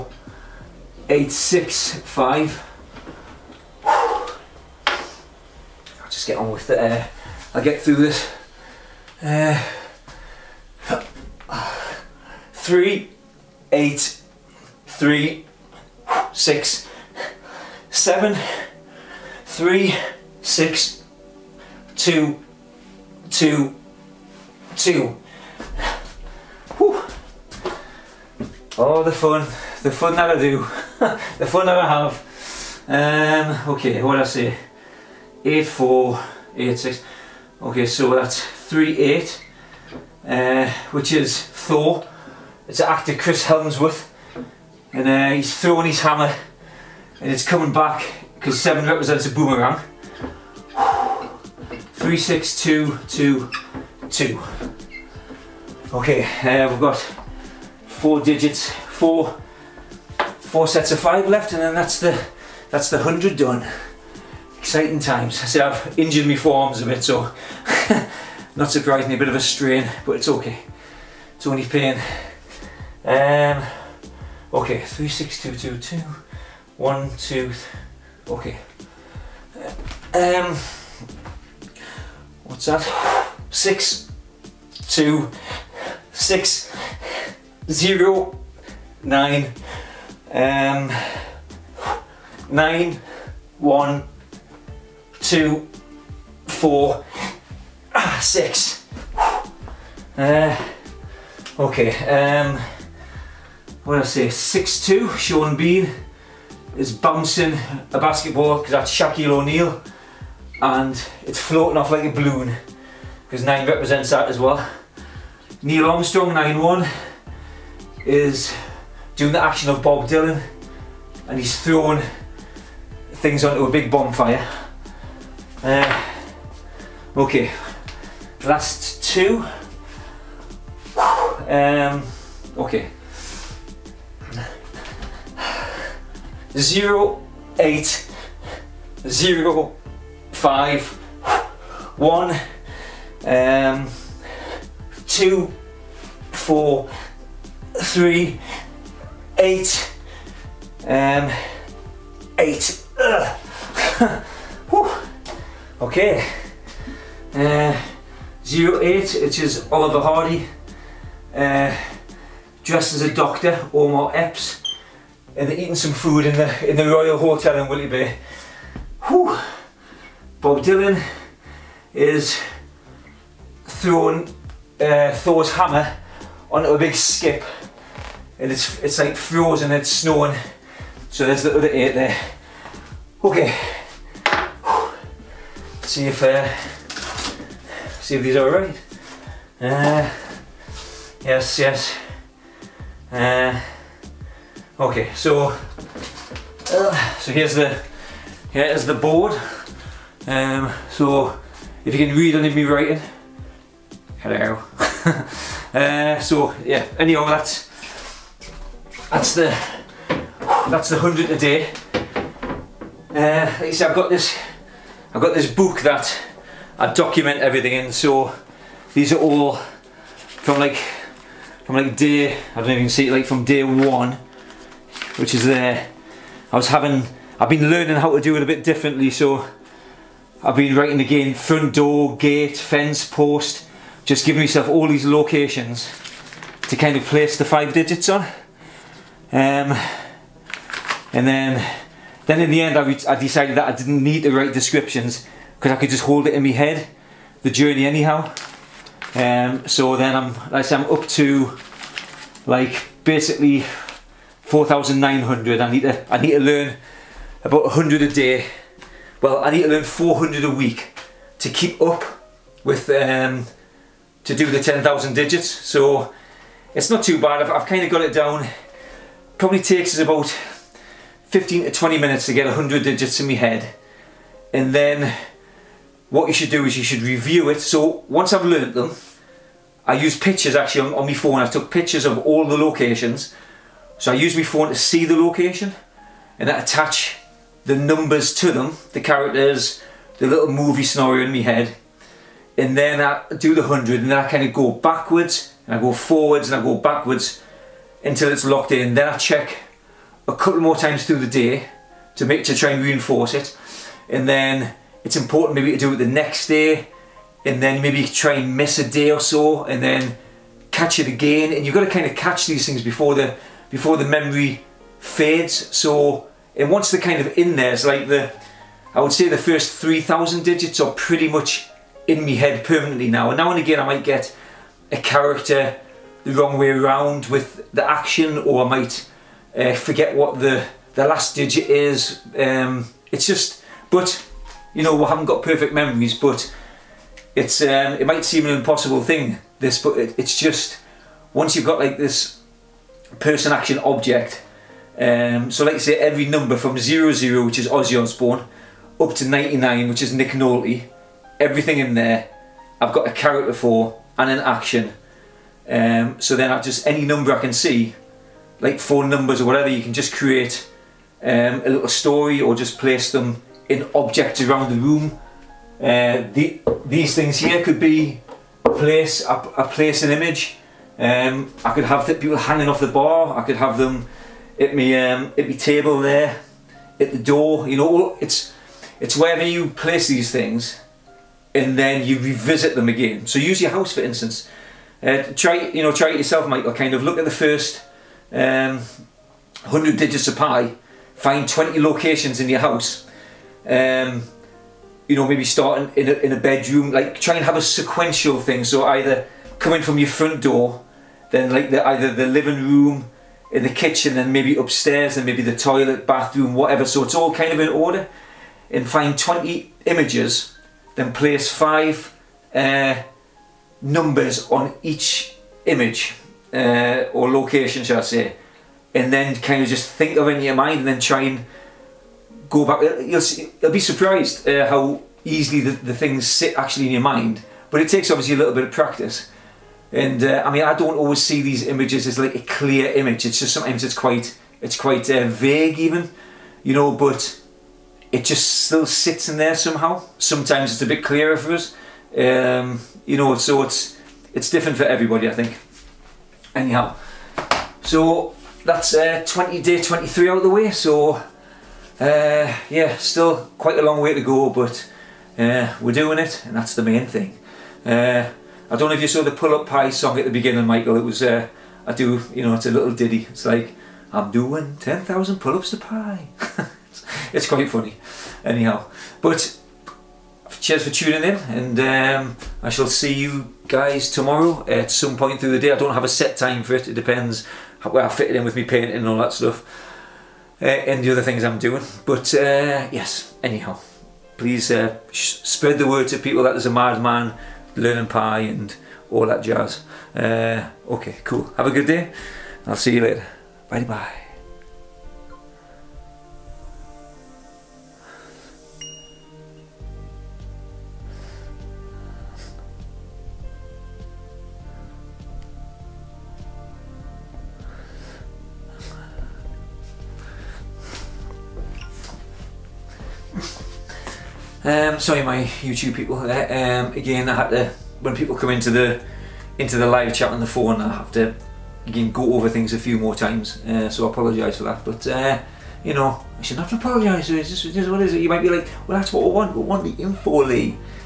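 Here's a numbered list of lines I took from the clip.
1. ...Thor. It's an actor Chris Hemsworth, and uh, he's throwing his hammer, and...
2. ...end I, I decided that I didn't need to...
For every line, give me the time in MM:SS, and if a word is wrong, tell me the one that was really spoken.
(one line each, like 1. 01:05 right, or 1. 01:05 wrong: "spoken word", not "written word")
1. 00:41 right
2. 04:02 right.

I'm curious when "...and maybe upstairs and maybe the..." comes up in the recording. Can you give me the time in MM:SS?
06:44.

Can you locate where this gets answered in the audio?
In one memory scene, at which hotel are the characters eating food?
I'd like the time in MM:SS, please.
02:46.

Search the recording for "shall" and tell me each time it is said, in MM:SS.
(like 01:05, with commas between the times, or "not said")
06:57, 07:52.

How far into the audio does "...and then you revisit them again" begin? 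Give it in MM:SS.
06:21.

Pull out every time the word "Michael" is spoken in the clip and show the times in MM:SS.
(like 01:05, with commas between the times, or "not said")
06:26, 07:40.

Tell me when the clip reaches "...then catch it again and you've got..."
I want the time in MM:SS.
05:09.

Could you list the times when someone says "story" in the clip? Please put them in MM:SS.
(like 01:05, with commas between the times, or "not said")
06:01.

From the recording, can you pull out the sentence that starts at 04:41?
I took pictures of all the locations.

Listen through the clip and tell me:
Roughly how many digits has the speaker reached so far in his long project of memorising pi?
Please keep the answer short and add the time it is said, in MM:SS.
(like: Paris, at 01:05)
4,900, at 04:14.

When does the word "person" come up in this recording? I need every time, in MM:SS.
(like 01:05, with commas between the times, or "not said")
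05:43.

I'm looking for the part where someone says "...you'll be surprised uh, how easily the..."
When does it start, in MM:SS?
07:03.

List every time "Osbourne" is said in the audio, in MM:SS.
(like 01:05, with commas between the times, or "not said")
05:48.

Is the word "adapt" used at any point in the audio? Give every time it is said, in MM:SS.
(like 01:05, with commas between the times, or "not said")
not said.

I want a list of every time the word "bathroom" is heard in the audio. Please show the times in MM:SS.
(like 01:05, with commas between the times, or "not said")
06:46.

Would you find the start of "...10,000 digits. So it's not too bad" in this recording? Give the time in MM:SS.
04:24.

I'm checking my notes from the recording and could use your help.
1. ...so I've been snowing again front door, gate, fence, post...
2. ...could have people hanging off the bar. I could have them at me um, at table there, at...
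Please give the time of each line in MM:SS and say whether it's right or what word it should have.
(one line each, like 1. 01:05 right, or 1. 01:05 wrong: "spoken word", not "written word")
1. 03:49 wrong: "writing", not "snowing"
2. 06:11 right.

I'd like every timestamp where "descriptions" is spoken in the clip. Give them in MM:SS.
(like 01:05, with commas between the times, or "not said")
04:04.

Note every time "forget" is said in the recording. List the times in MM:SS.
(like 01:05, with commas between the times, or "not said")
05:29.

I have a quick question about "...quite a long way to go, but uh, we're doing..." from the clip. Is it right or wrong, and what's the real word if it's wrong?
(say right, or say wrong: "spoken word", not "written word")
right.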